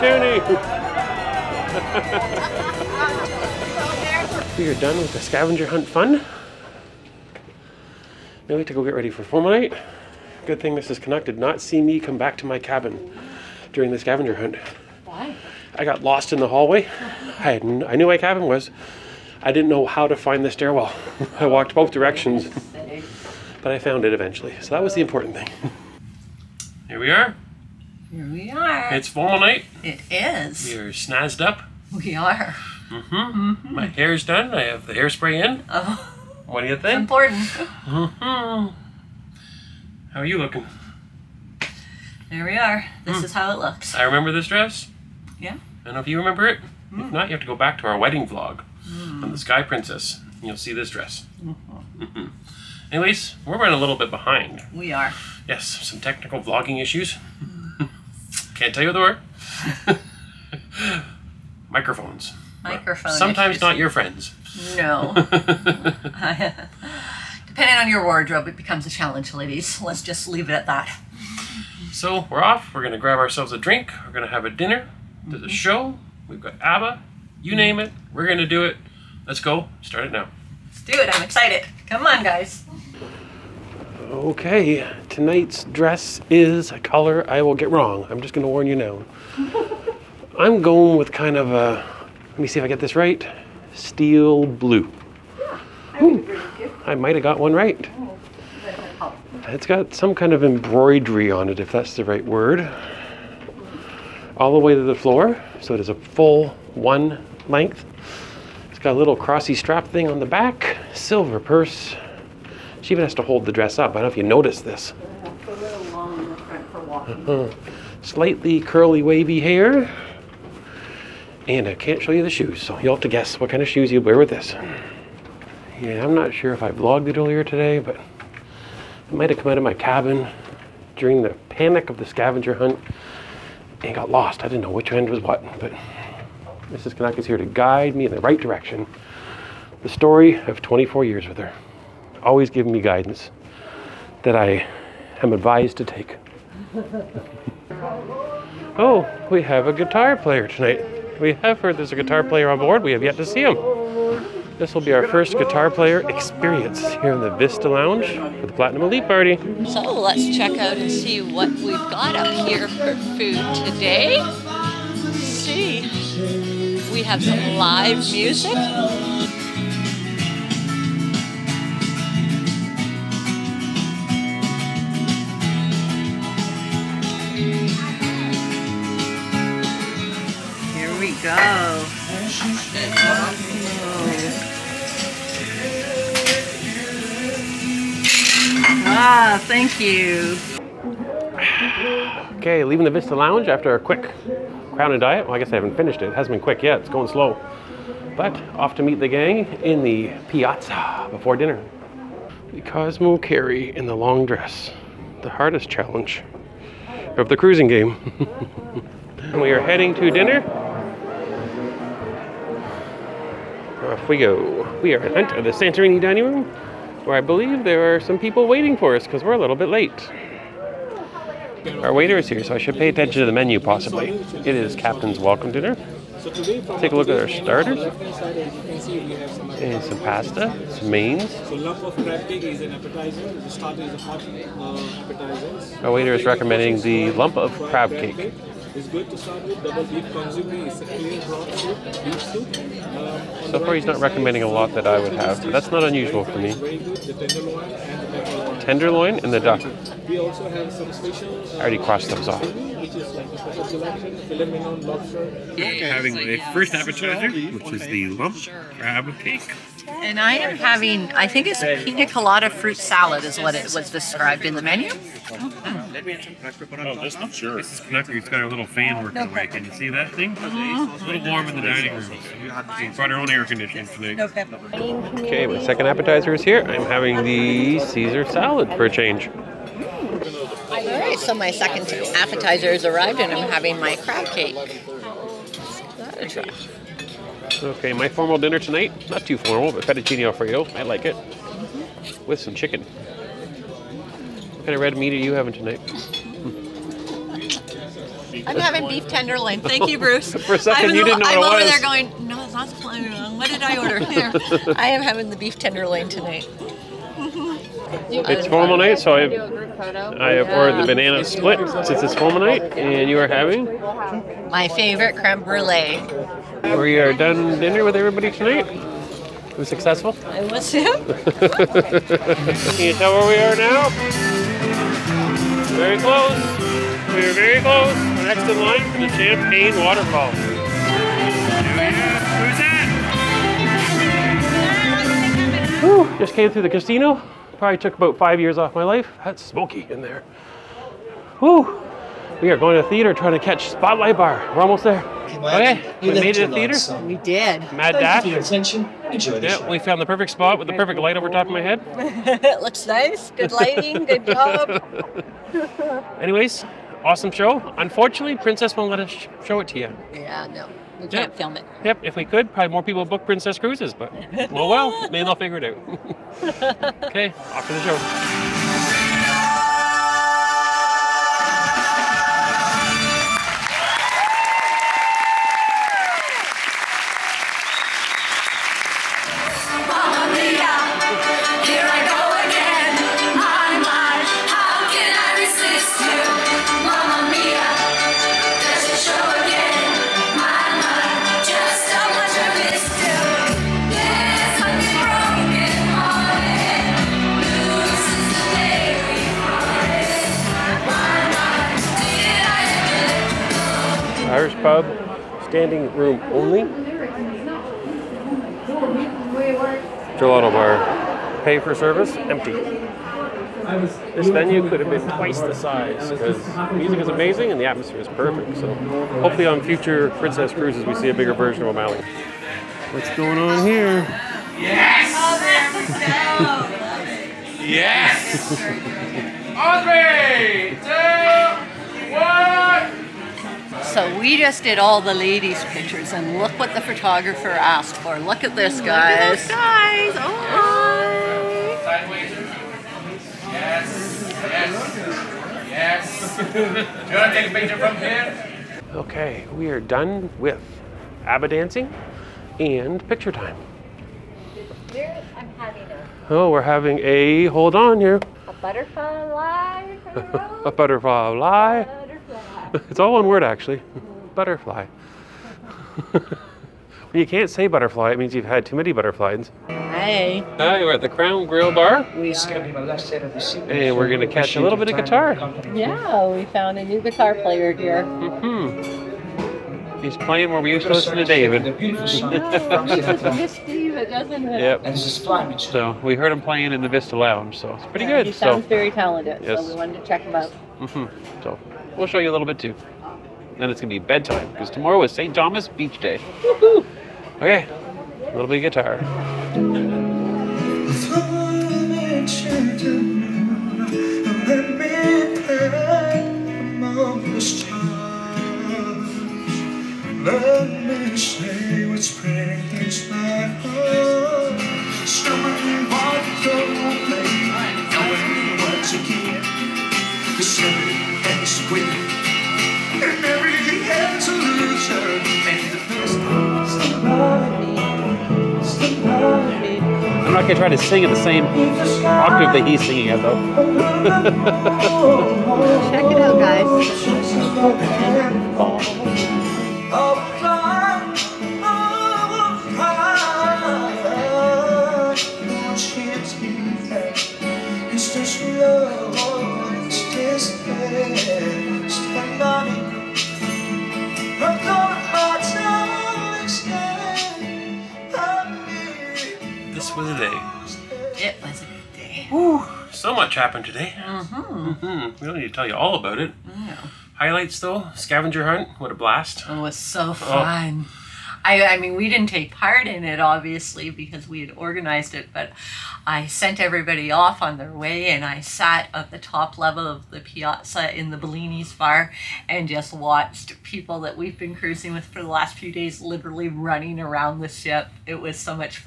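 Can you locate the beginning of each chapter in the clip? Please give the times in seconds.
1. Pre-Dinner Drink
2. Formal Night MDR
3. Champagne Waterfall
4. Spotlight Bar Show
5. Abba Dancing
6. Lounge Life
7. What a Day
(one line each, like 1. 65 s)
1. 25 s
2. 218 s
3. 322 s
4. 345 s
5. 379 s
6. 448 s
7. 559 s.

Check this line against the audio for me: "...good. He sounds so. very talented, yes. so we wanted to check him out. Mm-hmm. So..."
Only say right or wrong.
right.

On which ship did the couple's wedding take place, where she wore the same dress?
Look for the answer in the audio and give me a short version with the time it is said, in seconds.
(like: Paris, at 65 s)
Sky Princess, at 49 s.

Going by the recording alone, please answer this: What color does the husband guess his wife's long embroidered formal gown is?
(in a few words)
Steel blue.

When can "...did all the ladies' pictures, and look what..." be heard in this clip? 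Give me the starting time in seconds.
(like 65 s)
434 s.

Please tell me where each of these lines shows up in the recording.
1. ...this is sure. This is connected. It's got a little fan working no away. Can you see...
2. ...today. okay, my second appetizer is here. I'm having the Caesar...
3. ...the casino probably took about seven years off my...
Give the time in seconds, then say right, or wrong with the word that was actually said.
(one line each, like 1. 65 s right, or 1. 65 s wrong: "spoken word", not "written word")
1. 267 s right
2. 273 s right
3. 336 s wrong: "five", not "seven".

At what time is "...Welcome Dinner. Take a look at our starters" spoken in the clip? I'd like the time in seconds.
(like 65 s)
225 s.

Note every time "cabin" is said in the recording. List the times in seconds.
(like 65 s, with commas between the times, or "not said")
12 s, 18 s, 129 s.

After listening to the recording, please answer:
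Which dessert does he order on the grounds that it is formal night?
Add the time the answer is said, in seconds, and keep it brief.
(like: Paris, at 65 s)
Banana split, at 310 s.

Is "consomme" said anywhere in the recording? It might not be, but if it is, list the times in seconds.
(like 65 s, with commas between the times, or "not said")
240 s.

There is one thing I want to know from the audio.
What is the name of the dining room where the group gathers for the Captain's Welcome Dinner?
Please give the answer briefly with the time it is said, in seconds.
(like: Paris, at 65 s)
Santorini, at 215 s.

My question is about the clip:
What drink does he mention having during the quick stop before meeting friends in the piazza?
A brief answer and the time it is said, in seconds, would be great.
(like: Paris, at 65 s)
Crown and diet, at 194 s.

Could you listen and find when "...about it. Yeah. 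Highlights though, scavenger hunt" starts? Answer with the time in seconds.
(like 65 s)
565 s.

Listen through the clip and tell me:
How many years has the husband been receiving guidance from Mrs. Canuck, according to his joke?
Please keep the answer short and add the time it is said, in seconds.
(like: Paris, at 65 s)
24, at 140 s.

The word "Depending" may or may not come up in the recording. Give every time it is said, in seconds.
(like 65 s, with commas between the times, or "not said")
65 s.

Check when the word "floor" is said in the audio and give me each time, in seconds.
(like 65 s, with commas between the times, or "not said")
104 s.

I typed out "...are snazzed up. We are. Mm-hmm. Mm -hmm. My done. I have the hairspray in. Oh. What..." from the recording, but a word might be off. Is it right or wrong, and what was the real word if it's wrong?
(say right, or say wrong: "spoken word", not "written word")
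right.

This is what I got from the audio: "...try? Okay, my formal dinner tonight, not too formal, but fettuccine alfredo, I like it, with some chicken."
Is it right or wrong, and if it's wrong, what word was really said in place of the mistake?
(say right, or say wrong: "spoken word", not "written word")
right.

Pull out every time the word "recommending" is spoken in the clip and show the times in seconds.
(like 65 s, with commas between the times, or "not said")
236 s, 243 s.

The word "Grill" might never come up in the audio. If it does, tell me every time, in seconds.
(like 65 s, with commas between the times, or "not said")
471 s.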